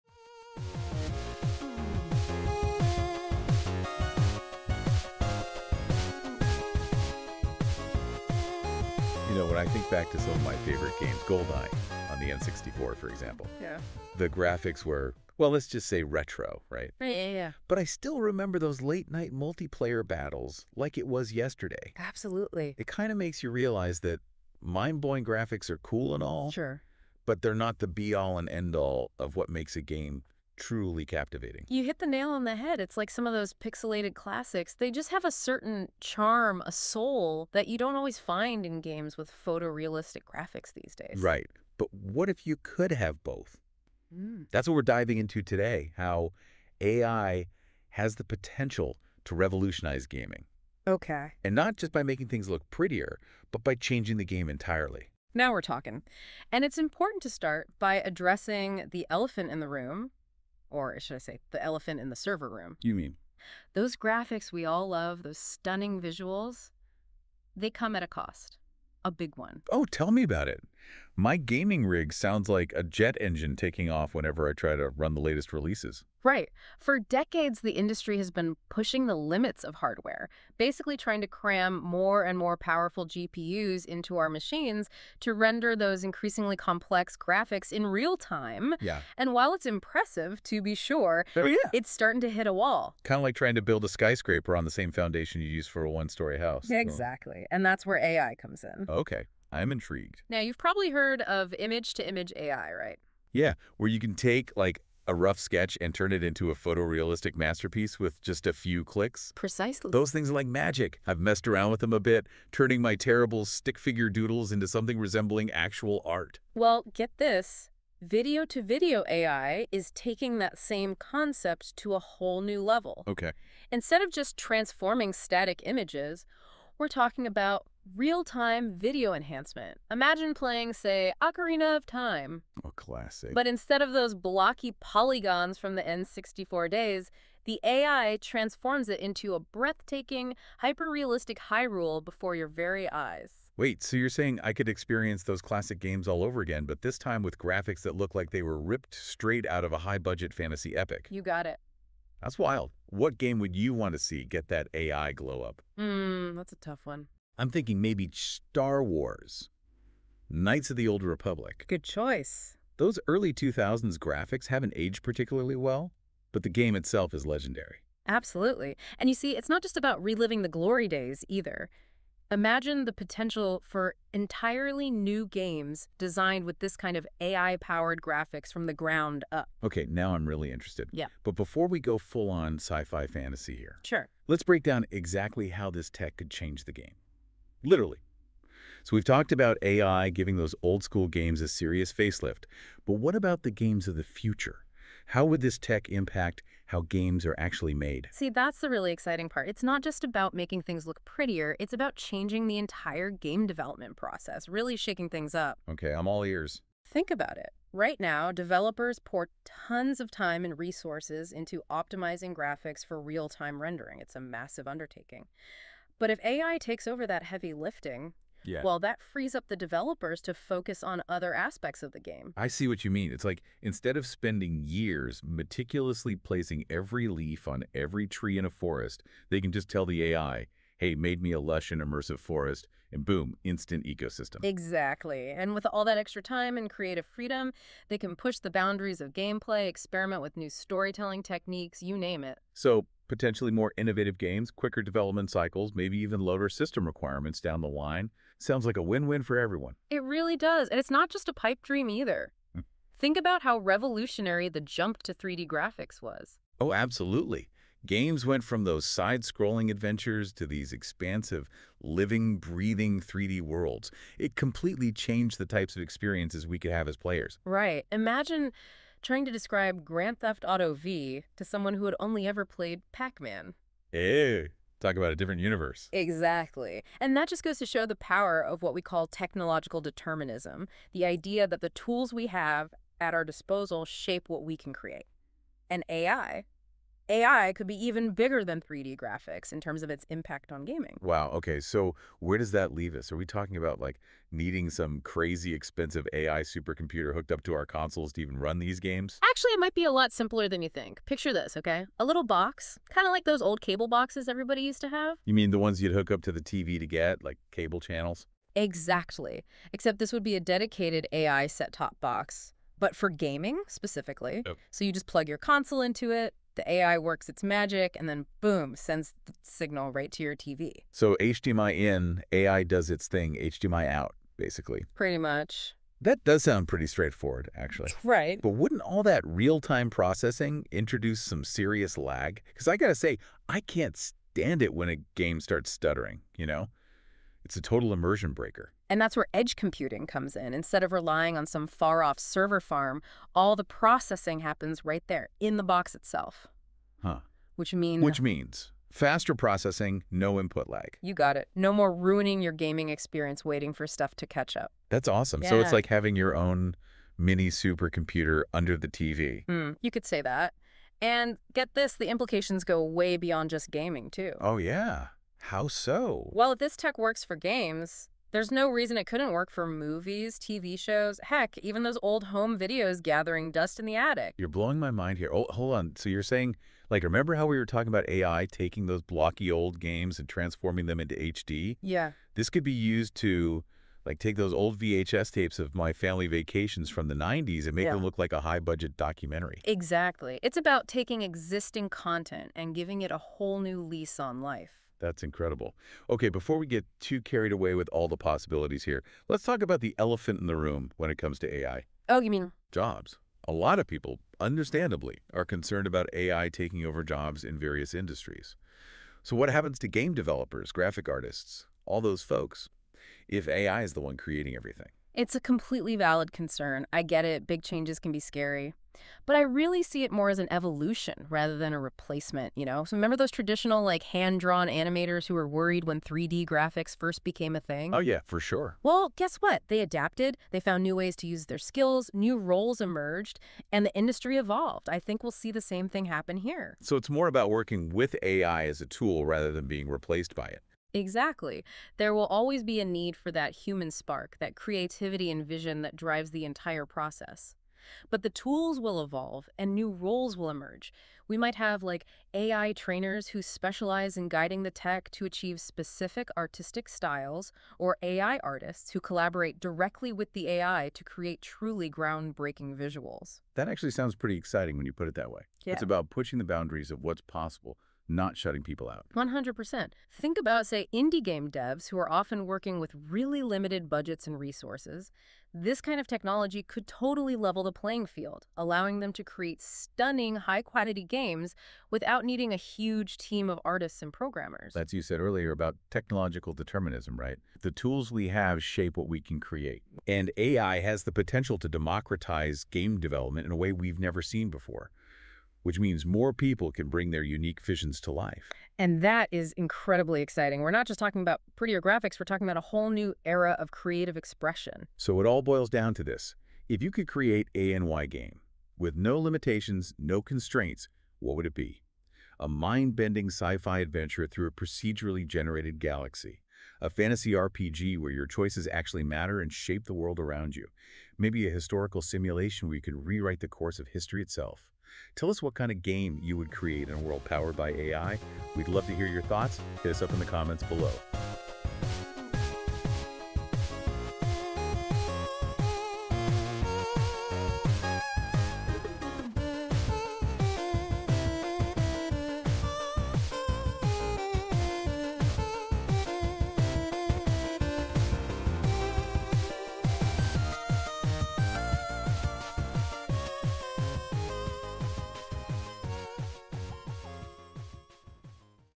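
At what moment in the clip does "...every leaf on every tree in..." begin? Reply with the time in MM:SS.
03:46.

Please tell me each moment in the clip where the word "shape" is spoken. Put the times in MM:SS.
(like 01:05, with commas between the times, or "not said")
04:43, 08:08, 08:39.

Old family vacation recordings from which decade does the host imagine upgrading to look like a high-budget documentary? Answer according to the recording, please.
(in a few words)
The 90s.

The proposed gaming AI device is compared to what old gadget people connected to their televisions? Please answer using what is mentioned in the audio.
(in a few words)
Cable boxes.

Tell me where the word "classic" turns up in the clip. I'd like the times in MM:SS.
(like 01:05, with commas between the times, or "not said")
00:34, 02:12, 02:25.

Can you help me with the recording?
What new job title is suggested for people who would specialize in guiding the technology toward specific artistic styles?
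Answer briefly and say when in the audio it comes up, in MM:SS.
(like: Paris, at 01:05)
AI trainers, at 07:32.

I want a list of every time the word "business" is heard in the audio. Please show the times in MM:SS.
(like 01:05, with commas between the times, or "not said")
not said.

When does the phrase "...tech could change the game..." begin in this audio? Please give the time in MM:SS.
03:05.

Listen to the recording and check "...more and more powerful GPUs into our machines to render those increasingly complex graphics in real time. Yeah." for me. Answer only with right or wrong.
right.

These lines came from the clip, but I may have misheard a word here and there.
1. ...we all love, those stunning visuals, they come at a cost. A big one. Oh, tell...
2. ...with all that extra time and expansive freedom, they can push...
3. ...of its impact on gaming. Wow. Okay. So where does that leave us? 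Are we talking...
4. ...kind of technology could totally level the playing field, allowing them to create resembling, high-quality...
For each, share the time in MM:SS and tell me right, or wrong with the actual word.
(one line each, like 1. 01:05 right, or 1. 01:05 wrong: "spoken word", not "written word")
1. 01:04 right
2. 03:55 wrong: "creative", not "expansive"
3. 04:49 right
4. 07:55 wrong: "stunning", not "resembling".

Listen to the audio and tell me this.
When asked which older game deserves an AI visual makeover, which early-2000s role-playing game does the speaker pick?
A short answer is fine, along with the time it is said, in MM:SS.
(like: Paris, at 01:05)
Knights of the Old Republic, at 02:40.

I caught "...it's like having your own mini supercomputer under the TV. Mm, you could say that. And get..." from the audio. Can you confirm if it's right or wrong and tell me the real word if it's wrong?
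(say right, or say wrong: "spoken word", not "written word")
right.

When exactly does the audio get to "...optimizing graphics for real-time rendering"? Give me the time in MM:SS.
03:31.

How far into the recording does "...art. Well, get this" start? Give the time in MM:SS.
01:56.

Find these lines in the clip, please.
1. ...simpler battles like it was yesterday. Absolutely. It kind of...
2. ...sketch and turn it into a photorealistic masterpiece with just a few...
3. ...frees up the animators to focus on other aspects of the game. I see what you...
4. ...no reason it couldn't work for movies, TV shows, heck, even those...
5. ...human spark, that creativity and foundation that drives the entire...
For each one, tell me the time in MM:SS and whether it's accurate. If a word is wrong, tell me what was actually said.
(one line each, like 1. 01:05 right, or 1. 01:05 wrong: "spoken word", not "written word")
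1. 00:19 wrong: "multiplayer", not "simpler"
2. 01:45 right
3. 03:39 wrong: "developers", not "animators"
4. 06:08 right
5. 07:23 wrong: "vision", not "foundation".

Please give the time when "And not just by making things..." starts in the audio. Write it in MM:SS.
00:51.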